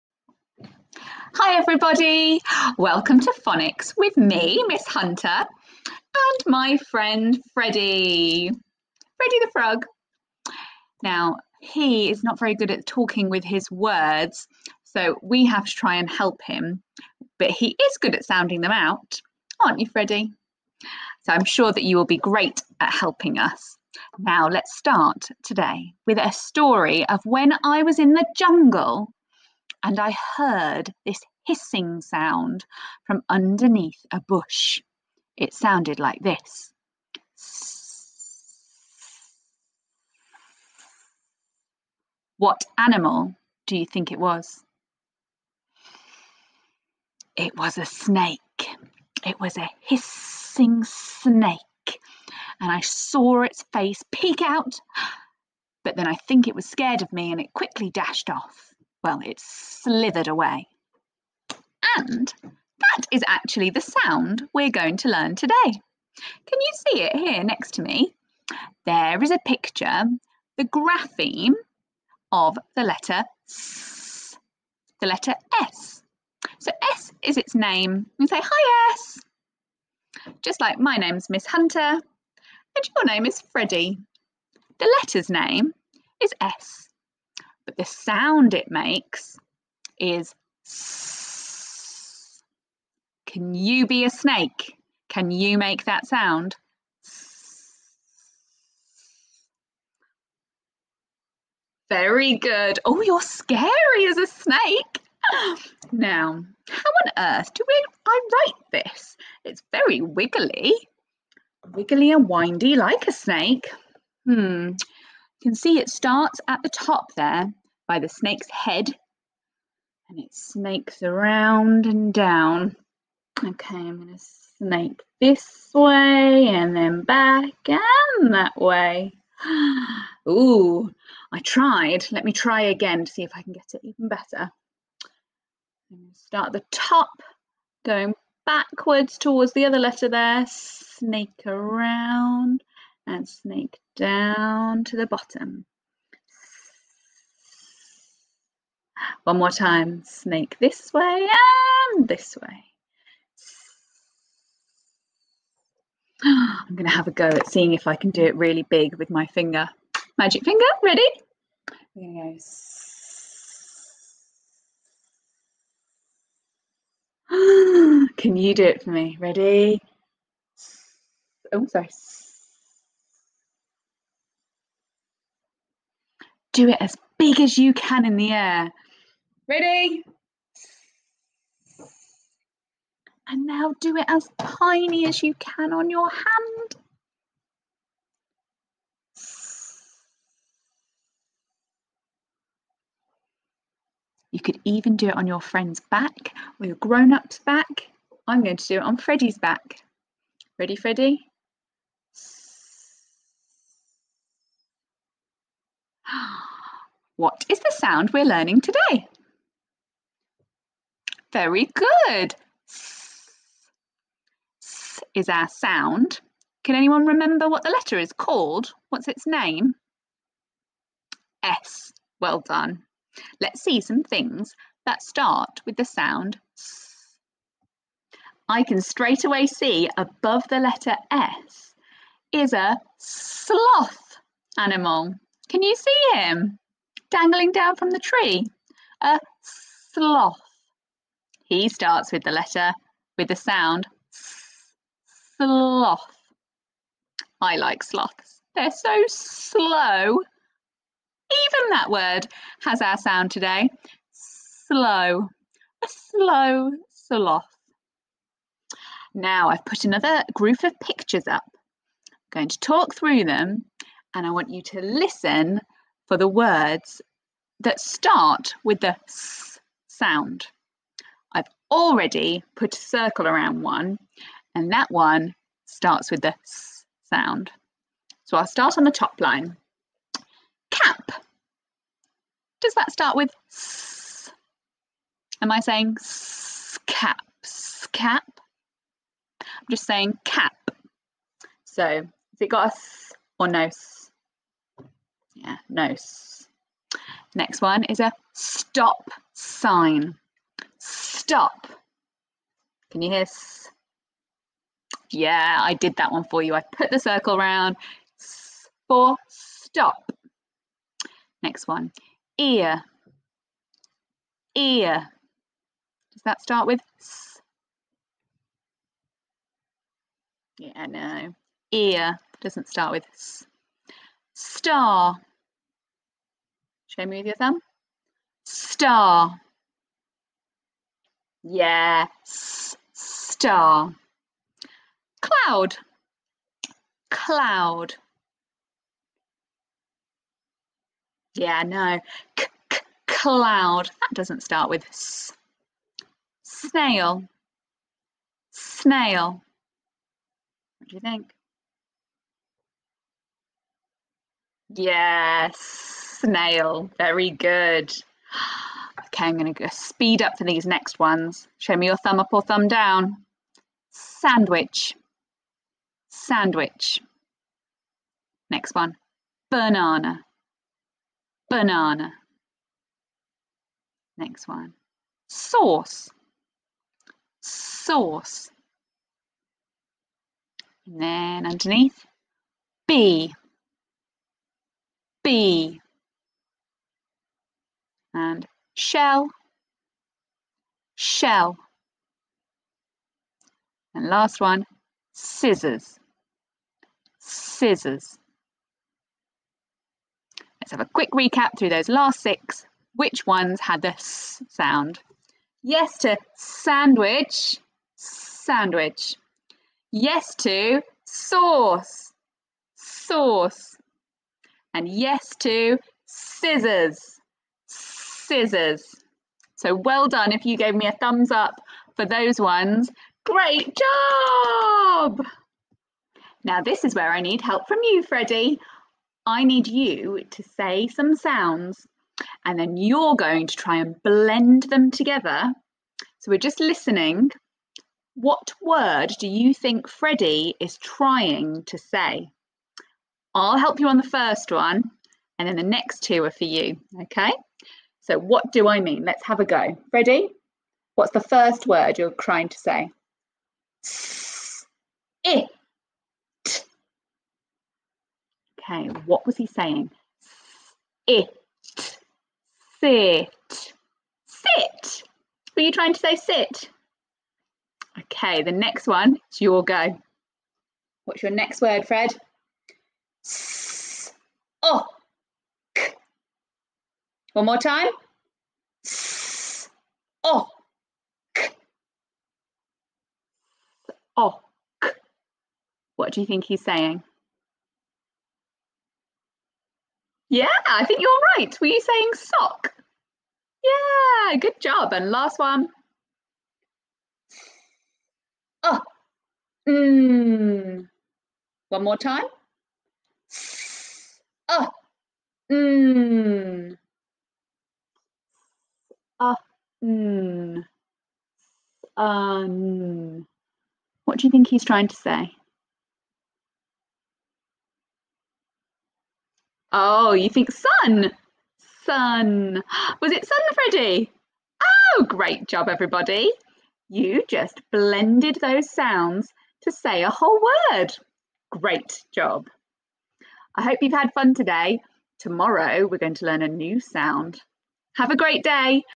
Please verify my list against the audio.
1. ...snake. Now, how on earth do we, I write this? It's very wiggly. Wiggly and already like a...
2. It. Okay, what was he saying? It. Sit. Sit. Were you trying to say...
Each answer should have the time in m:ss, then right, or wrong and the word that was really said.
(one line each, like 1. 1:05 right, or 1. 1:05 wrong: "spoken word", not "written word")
1. 1:44 wrong: "windy", not "already"
2. 7:35 right.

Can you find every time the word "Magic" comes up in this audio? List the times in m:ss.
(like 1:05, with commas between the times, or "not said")
2:40.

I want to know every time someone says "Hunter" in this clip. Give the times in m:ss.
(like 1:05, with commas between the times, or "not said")
0:04, 1:21.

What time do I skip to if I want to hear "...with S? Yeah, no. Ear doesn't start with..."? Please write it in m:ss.
5:16.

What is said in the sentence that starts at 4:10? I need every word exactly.
Even that word has our sound today.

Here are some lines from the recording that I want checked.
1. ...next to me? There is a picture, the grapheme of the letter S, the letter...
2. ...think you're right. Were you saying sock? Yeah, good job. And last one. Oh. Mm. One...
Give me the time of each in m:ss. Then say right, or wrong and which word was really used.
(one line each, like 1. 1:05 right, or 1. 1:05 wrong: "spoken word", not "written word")
1. 1:07 right
2. 8:10 right.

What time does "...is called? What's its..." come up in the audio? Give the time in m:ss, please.
3:37.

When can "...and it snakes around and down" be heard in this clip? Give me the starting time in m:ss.
2:00.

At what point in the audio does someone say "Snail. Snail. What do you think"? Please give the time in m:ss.
5:46.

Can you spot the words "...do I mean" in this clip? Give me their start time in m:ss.
7:28.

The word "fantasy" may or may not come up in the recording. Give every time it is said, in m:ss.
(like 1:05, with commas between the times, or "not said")
not said.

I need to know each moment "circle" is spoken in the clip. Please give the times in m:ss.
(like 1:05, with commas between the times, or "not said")
4:32, 5:06.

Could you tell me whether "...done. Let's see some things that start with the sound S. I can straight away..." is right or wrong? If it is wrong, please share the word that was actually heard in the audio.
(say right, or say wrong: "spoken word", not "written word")
right.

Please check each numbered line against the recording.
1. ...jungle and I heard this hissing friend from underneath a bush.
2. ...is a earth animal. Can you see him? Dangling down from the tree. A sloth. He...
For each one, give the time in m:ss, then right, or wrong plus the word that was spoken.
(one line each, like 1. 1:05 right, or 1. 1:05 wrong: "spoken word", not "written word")
1. 0:28 wrong: "sound", not "friend"
2. 3:52 wrong: "sloth", not "earth".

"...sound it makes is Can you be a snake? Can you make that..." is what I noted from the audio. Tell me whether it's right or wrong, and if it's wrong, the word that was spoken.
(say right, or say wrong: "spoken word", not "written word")
right.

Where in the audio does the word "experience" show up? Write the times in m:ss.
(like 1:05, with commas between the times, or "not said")
not said.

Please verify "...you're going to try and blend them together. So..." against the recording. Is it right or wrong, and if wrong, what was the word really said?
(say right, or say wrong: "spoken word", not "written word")
right.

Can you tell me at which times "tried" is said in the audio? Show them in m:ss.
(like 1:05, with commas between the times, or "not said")
2:11.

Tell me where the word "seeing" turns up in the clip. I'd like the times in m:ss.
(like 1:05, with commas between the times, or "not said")
2:37.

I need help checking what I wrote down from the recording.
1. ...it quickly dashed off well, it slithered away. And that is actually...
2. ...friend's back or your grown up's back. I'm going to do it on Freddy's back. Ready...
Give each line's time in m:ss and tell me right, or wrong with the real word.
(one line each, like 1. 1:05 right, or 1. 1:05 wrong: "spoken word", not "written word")
1. 0:57 right
2. 3:15 right.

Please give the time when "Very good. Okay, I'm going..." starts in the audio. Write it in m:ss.
5:56.